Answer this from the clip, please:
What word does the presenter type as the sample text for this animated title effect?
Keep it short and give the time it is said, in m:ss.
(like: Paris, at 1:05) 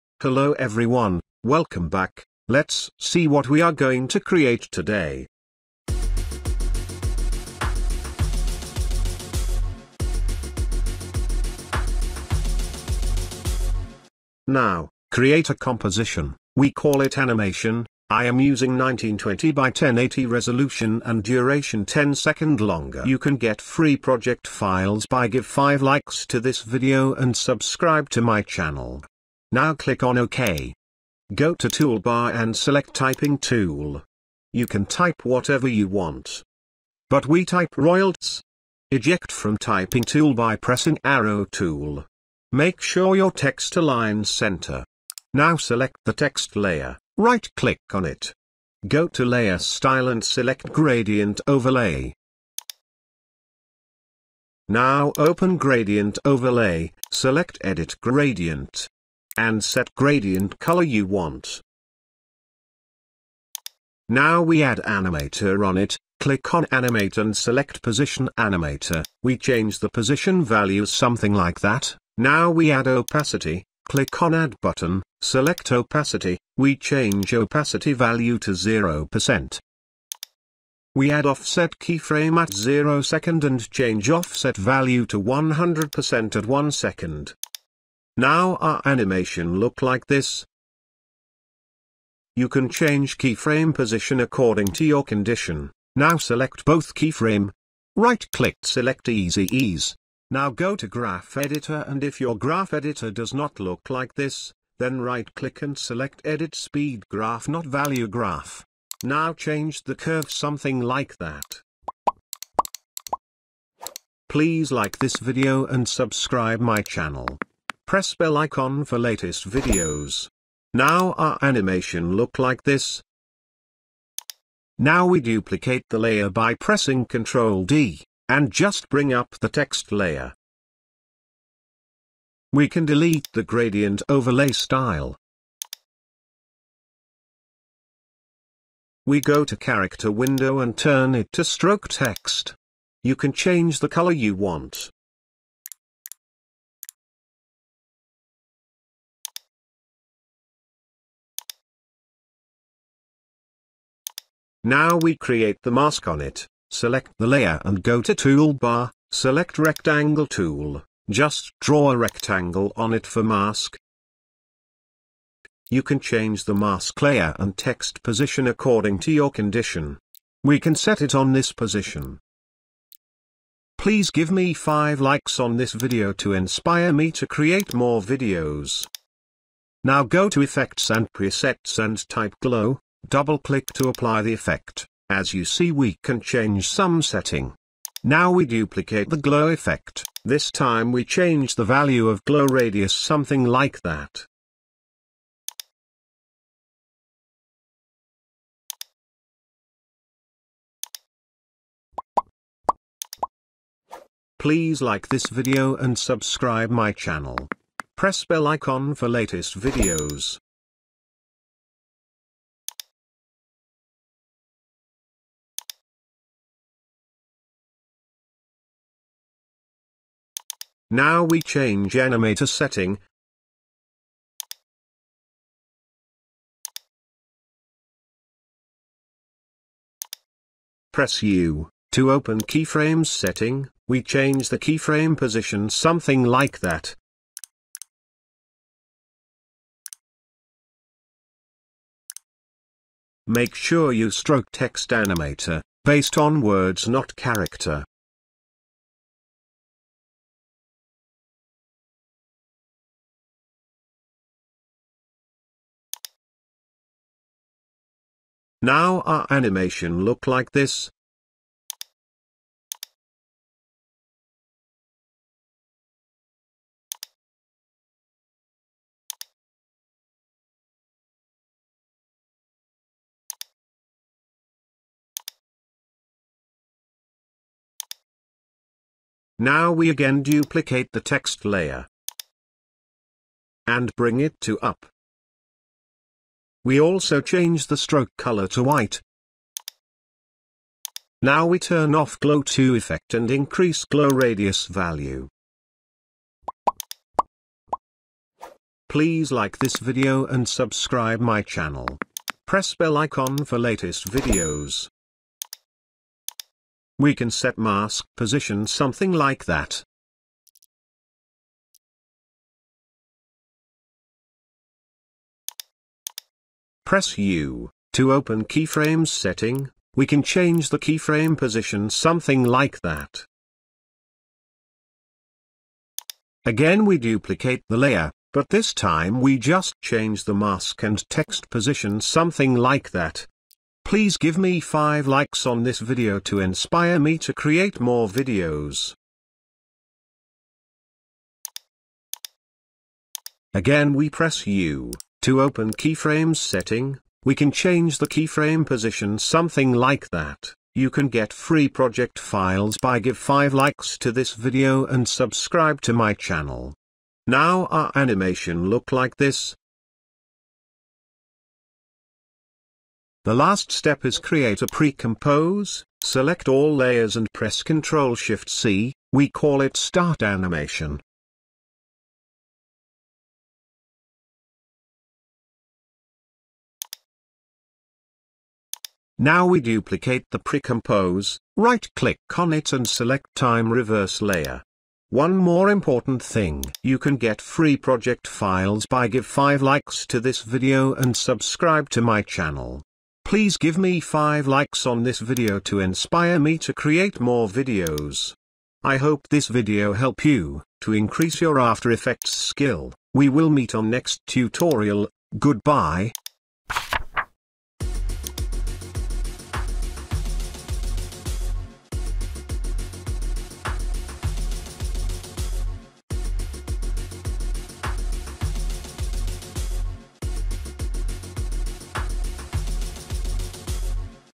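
royalties, at 0:37.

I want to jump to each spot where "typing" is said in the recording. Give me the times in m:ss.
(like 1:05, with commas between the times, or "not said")
0:32, 0:39.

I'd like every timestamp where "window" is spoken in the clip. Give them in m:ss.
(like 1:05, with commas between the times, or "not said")
2:20.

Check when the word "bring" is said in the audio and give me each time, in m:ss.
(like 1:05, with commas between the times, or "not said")
2:08, 4:43.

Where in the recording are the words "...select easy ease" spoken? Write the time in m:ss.
1:38.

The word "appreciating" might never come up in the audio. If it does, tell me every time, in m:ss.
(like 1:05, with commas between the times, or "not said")
not said.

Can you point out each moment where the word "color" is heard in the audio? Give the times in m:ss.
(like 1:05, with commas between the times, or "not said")
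1:00, 2:23, 4:48.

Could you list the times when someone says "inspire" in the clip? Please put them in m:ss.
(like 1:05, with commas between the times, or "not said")
2:56, 5:36, 6:35.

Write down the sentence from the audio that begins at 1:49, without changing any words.
Now change the curve something like that.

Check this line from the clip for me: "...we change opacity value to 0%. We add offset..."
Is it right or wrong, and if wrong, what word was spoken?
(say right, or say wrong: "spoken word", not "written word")
right.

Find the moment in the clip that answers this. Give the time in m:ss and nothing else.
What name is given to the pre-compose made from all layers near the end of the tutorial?
6:09.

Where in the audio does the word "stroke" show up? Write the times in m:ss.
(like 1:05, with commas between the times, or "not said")
2:21, 4:04, 4:47.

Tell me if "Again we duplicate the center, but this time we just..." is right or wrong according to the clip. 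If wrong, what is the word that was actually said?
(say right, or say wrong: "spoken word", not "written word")
wrong: "layer", not "center".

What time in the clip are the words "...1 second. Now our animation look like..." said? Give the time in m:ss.
1:26.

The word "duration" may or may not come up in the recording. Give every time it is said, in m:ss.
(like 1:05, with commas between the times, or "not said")
0:21.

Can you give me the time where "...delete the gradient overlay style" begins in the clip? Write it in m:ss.
2:12.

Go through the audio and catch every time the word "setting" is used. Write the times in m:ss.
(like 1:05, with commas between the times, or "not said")
3:07, 3:42, 3:53, 5:19, 5:46.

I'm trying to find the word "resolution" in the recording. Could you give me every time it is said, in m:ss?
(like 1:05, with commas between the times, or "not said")
0:20.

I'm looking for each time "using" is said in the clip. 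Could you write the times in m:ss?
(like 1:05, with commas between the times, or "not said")
0:18.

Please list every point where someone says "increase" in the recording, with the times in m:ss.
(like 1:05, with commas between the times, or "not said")
4:53, 6:40.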